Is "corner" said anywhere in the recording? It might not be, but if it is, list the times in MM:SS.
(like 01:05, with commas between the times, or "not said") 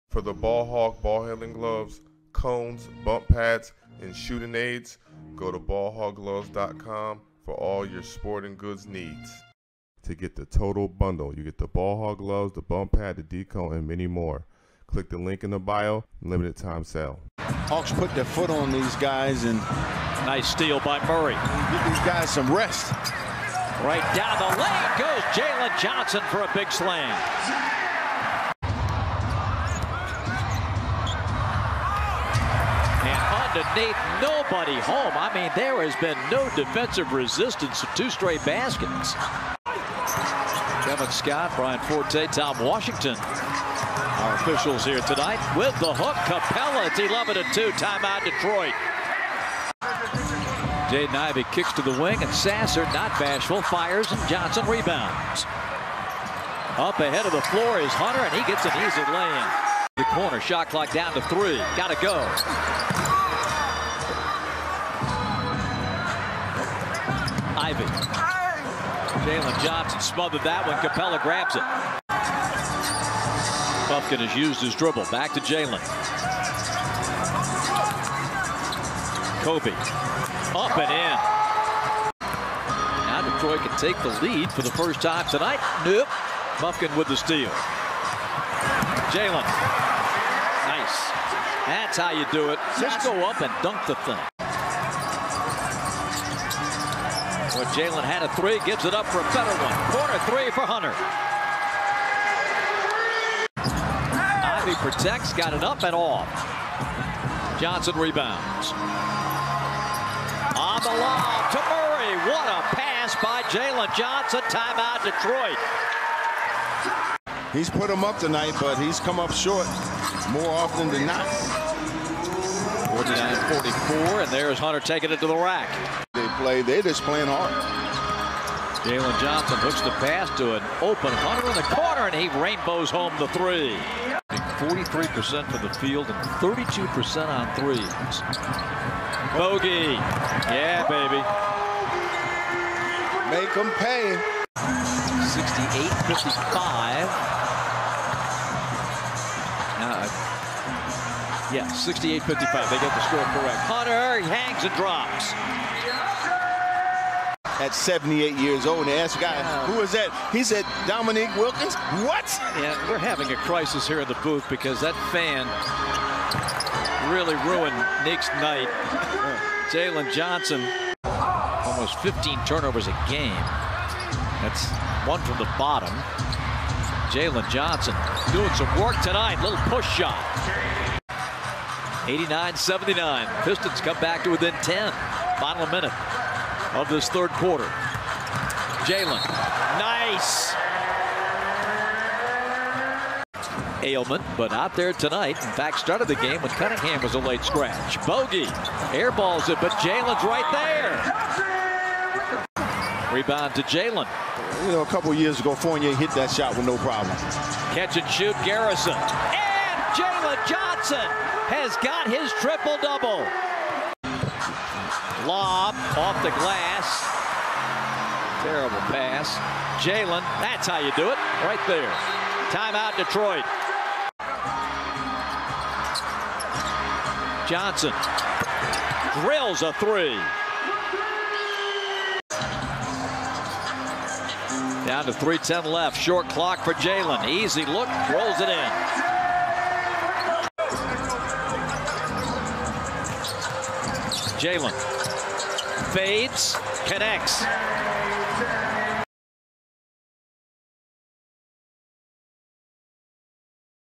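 01:00, 01:39, 02:11.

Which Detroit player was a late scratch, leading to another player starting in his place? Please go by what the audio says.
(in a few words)
Cunningham.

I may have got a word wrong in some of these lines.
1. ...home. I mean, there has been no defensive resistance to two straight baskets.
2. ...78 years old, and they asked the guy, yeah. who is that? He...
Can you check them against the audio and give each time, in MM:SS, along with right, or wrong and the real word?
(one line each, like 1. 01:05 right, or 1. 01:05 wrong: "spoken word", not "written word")
1. 00:34 right
2. 02:37 right.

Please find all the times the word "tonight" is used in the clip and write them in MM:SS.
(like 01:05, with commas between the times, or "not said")
00:45, 01:25, 01:58, 02:59, 03:14.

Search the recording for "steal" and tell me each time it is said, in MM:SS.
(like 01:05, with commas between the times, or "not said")
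00:20, 01:27.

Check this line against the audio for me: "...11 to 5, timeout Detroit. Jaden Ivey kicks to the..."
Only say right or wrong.
wrong.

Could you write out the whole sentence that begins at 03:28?
And Johnson has got his triple-double.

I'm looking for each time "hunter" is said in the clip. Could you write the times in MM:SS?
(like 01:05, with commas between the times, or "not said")
00:57, 01:40, 02:04, 02:11, 02:33.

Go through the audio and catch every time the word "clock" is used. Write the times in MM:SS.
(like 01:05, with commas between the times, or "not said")
01:00, 03:56.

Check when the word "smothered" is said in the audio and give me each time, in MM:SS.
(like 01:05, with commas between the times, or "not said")
01:09.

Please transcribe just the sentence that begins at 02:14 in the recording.
43% from the field and 32% on threes.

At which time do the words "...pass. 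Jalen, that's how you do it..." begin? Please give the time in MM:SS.
03:38.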